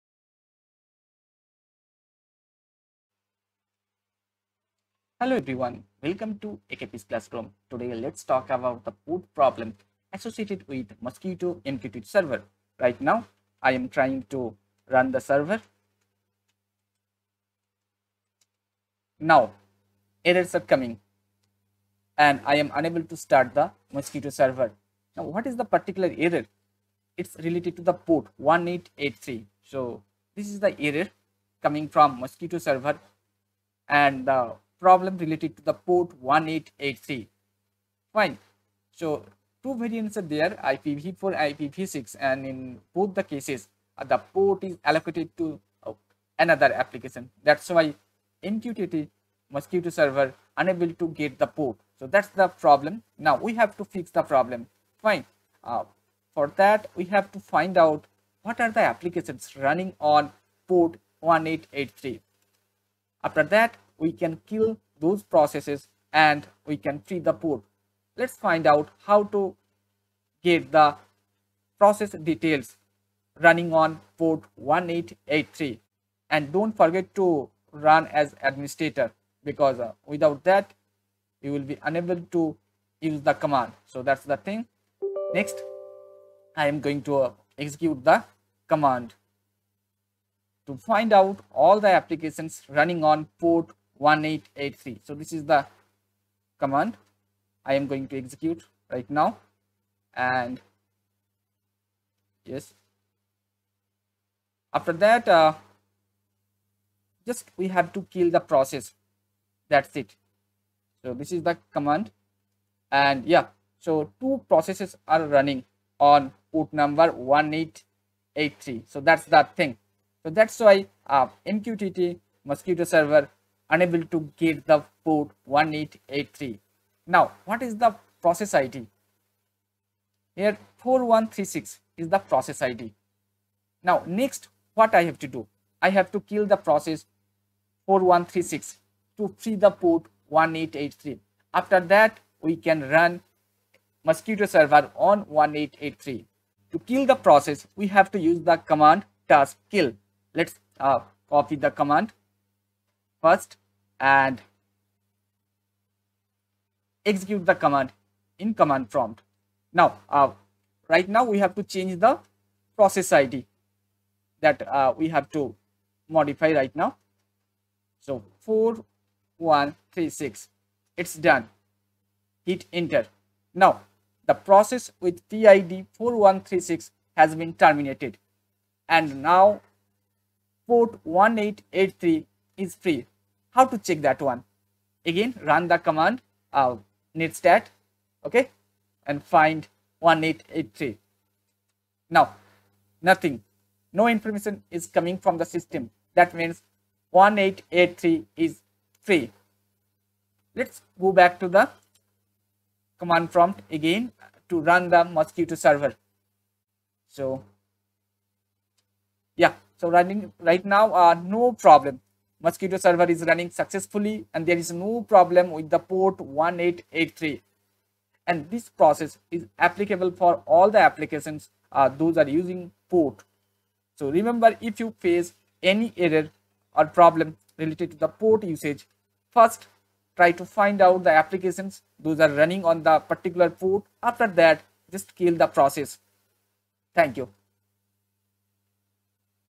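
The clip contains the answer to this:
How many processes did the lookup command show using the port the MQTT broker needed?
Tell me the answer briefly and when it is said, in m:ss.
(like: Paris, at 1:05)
2, at 1:54.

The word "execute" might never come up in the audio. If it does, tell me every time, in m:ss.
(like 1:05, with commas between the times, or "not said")
1:27, 1:38, 2:37.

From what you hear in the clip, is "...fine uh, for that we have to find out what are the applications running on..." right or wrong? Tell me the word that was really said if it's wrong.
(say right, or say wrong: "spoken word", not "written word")
right.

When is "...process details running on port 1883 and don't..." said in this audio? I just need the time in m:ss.
1:11.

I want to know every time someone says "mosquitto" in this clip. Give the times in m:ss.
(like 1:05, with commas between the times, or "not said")
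0:10, 0:23, 0:32, 0:49, 2:02, 2:24, 3:25, 3:32.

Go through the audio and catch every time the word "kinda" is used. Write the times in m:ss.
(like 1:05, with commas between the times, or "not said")
not said.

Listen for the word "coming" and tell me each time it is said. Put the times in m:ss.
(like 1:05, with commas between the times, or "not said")
0:20, 0:31, 3:14.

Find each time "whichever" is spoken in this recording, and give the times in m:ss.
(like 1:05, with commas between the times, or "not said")
not said.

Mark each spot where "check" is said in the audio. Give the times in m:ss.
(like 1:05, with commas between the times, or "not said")
3:03.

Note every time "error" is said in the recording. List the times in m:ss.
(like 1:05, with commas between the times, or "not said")
0:20, 0:26, 0:30, 3:45.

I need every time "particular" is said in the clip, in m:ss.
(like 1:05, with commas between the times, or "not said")
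0:25, 3:52.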